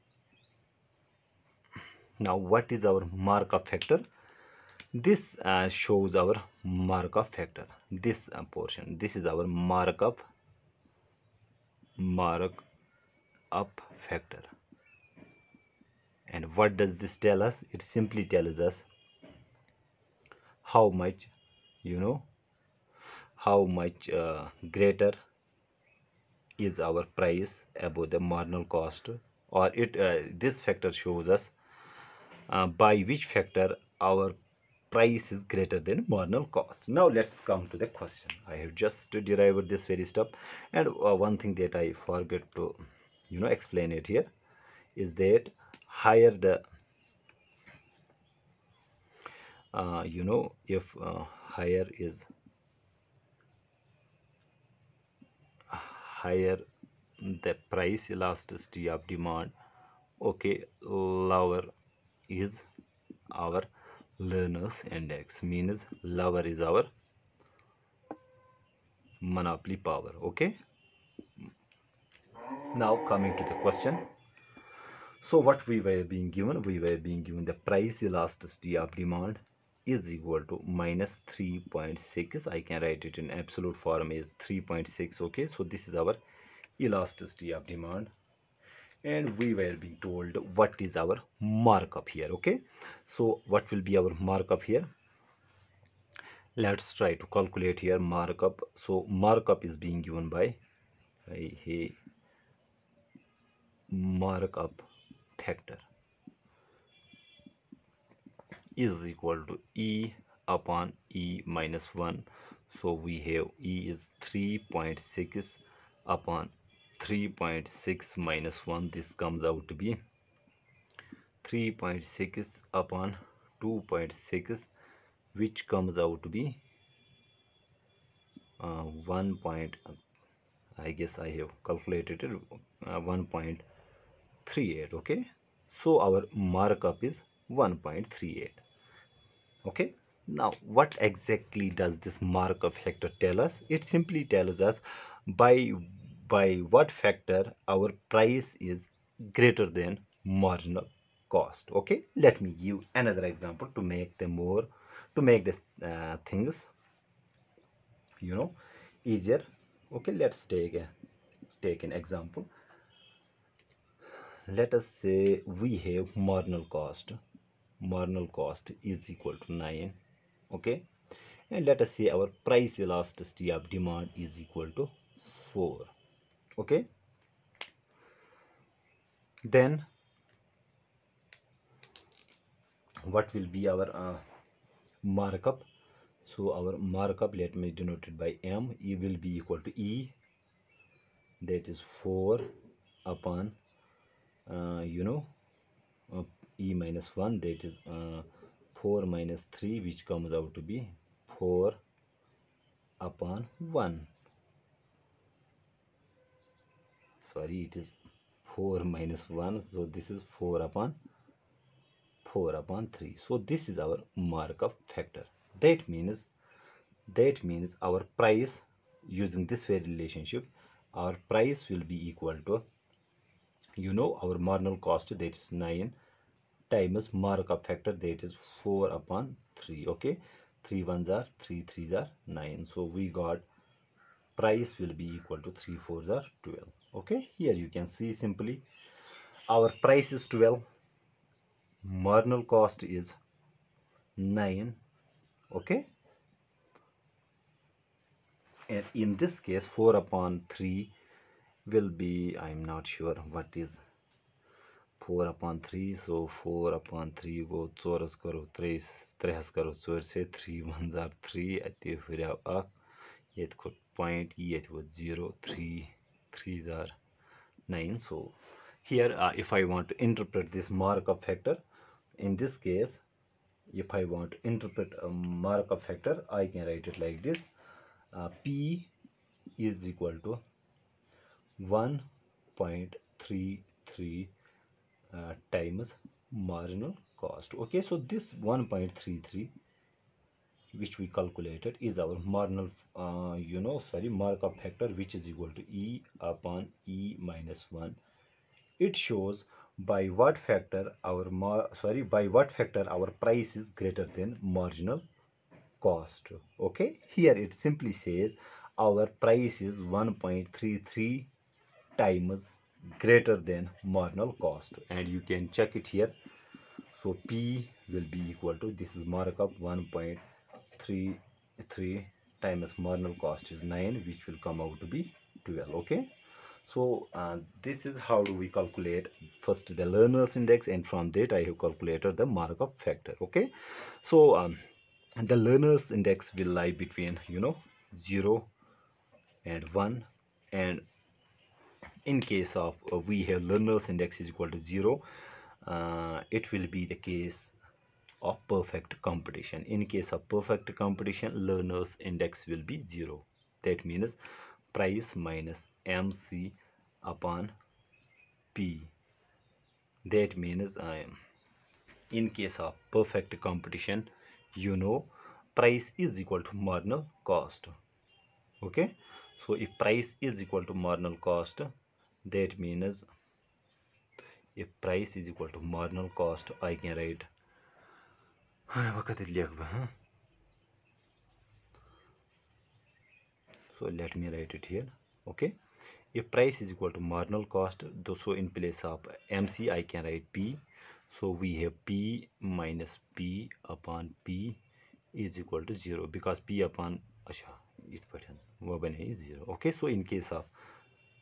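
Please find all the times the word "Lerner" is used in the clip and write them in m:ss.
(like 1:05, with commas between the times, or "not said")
1:04, 5:29, 5:35, 5:43, 5:51.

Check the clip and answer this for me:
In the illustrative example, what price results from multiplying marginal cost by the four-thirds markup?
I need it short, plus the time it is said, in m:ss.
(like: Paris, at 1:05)
12, at 3:59.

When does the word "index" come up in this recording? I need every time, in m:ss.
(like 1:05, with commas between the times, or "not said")
1:04, 5:30, 5:35, 5:43, 5:52.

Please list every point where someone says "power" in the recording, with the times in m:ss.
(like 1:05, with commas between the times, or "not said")
1:09.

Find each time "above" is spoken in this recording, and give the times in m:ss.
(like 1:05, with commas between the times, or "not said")
0:27.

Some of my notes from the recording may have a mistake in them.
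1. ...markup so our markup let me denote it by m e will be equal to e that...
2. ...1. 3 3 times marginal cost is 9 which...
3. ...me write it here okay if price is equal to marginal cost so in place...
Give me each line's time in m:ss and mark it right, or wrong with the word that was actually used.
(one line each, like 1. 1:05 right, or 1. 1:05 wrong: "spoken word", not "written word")
1. 3:05 right
2. 5:19 right
3. 6:24 right.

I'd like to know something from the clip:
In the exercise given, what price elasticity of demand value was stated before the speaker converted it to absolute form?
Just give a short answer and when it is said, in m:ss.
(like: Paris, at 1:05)
-3.6, at 1:20.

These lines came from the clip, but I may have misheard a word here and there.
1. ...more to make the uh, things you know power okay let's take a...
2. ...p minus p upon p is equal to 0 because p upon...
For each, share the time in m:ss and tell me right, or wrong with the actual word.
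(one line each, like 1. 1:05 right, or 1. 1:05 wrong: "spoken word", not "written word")
1. 2:34 wrong: "easier", not "power"
2. 6:31 right.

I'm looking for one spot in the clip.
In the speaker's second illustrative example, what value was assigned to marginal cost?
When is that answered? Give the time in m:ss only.
2:47.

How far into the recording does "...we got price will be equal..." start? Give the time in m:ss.
3:52.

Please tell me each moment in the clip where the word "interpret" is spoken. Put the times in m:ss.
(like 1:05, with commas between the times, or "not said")
4:30, 4:34.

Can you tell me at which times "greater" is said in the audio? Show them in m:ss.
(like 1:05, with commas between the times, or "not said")
0:24, 0:35, 2:29, 5:03, 5:13.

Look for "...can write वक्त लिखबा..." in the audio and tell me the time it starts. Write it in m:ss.
6:16.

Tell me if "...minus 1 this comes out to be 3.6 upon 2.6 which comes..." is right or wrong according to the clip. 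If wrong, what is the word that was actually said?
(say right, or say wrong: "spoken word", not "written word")
right.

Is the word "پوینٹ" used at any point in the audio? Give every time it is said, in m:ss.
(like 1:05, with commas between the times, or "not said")
4:23.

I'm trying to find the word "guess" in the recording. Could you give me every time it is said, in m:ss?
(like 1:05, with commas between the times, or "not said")
2:10.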